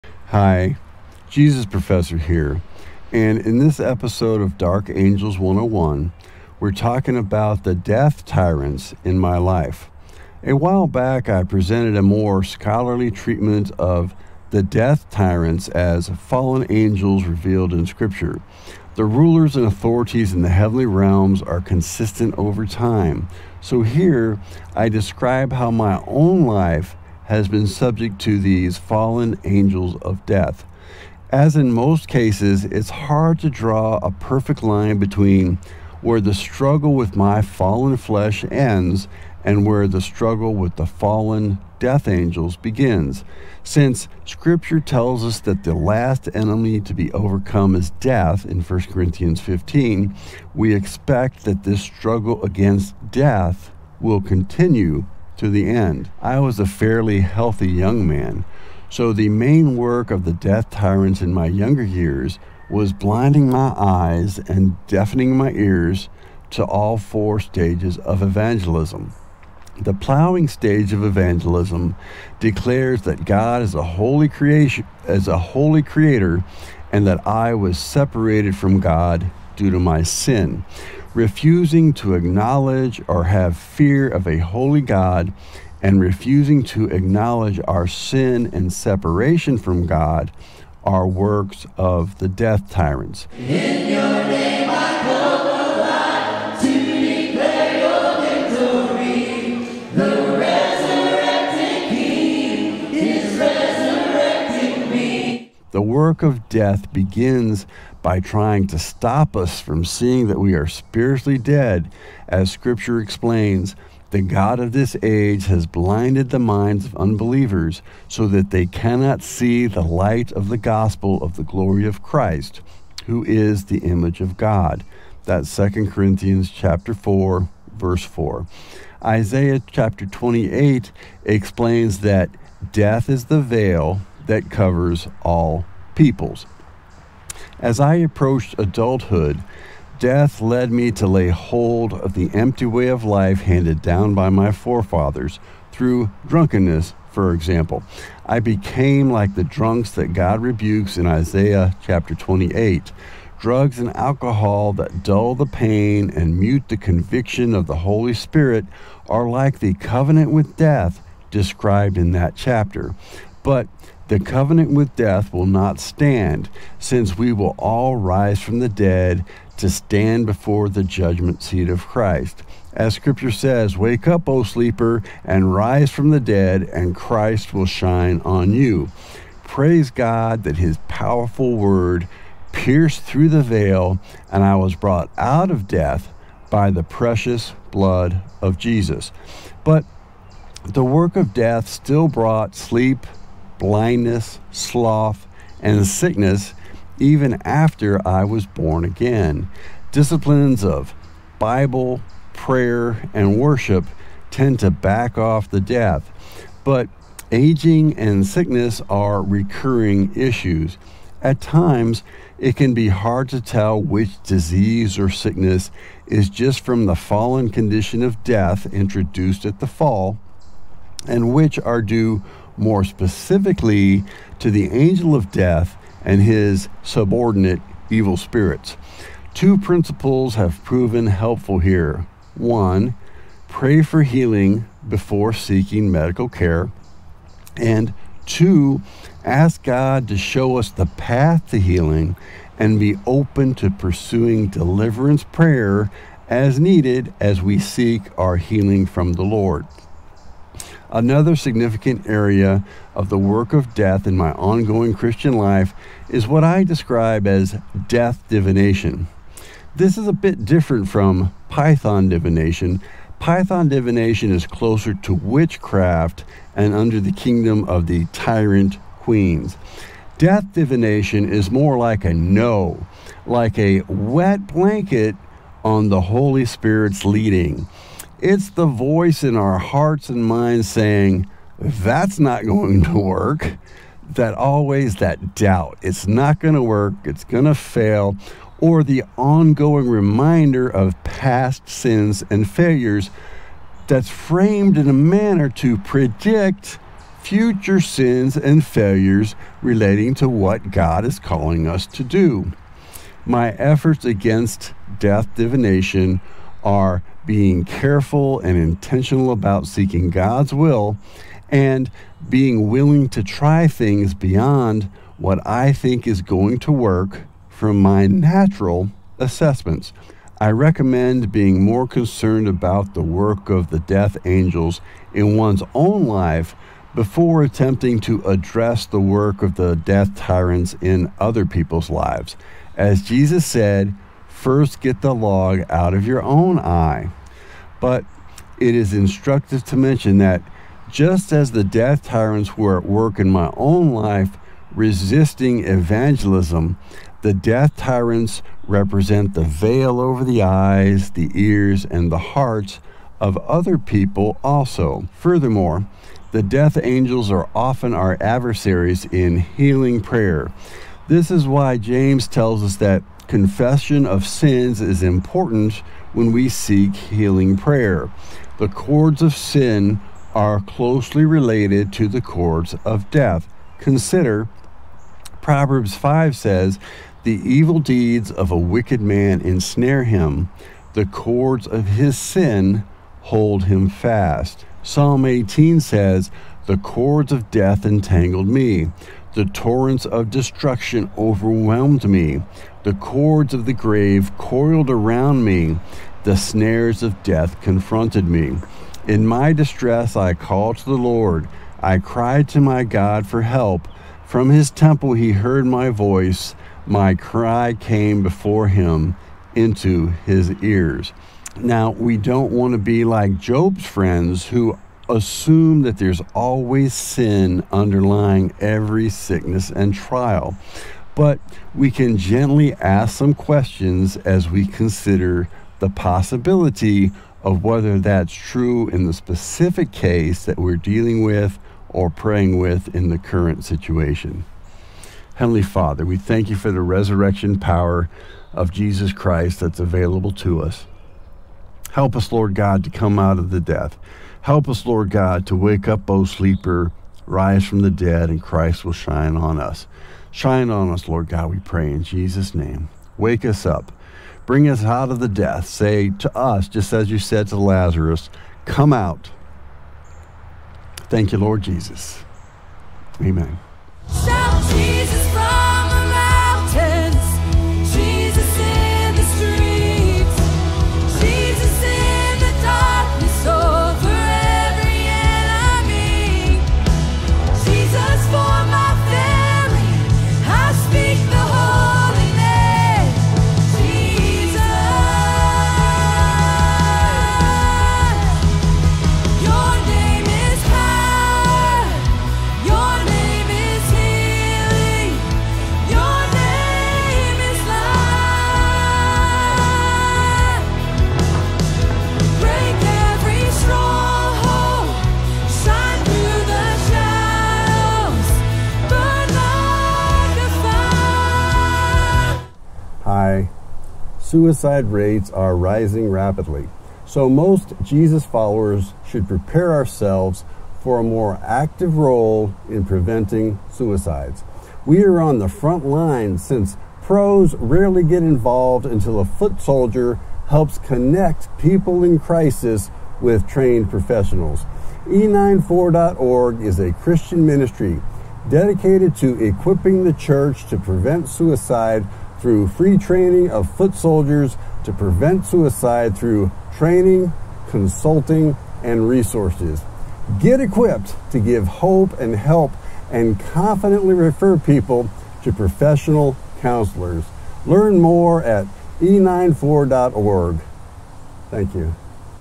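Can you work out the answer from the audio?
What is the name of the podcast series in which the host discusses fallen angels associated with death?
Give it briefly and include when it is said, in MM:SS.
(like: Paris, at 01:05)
Dark Angels 101, at 00:04.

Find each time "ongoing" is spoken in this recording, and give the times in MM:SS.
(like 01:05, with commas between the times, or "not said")
04:14, 04:49.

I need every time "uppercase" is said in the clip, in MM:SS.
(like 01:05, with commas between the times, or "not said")
not said.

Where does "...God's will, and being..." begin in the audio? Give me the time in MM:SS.
05:10.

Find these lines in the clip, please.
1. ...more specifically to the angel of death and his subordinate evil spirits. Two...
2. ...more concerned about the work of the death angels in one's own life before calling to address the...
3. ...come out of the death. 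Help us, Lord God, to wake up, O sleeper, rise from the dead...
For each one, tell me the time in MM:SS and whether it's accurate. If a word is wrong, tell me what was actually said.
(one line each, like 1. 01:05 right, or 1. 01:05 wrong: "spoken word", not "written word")
1. 03:42 right
2. 05:21 wrong: "attempting", not "calling"
3. 07:22 right.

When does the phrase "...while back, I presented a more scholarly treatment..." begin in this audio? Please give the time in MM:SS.
00:10.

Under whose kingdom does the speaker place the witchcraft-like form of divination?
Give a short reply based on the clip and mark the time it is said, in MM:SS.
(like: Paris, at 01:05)
the tyrant queens, at 04:28.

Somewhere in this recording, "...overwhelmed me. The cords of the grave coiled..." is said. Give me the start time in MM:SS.
06:31.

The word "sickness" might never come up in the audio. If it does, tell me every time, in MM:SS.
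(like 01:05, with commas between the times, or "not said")
03:15, 03:28, 03:35, 06:59.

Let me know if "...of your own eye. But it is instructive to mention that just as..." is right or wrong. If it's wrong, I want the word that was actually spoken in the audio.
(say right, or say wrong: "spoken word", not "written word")
right.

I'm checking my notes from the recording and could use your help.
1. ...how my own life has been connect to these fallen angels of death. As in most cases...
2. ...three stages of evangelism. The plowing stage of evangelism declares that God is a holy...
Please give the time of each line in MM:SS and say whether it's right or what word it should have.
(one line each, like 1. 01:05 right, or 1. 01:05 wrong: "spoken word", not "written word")
1. 00:25 wrong: "subject", not "connect"
2. 01:06 wrong: "four", not "three".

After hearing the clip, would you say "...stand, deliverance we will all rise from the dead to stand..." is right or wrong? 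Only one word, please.
wrong.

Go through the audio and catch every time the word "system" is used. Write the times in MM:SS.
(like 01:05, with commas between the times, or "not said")
not said.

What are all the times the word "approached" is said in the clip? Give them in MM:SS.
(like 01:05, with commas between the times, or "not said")
02:17.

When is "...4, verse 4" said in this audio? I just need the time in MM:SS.
02:06.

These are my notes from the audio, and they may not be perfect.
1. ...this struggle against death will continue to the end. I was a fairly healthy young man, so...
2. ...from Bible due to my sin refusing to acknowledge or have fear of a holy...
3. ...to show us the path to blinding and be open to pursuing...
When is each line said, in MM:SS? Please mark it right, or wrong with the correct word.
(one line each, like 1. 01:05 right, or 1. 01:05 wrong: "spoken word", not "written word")
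1. 00:51 right
2. 01:18 wrong: "God", not "Bible"
3. 04:00 wrong: "healing", not "blinding".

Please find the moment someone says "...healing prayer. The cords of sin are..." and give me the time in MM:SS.
06:06.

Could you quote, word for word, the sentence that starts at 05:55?
Furthermore, the death angels are often our adversaries in healing prayer.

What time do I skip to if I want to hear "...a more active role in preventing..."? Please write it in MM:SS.
08:40.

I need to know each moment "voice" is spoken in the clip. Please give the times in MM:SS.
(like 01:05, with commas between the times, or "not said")
04:38, 06:45.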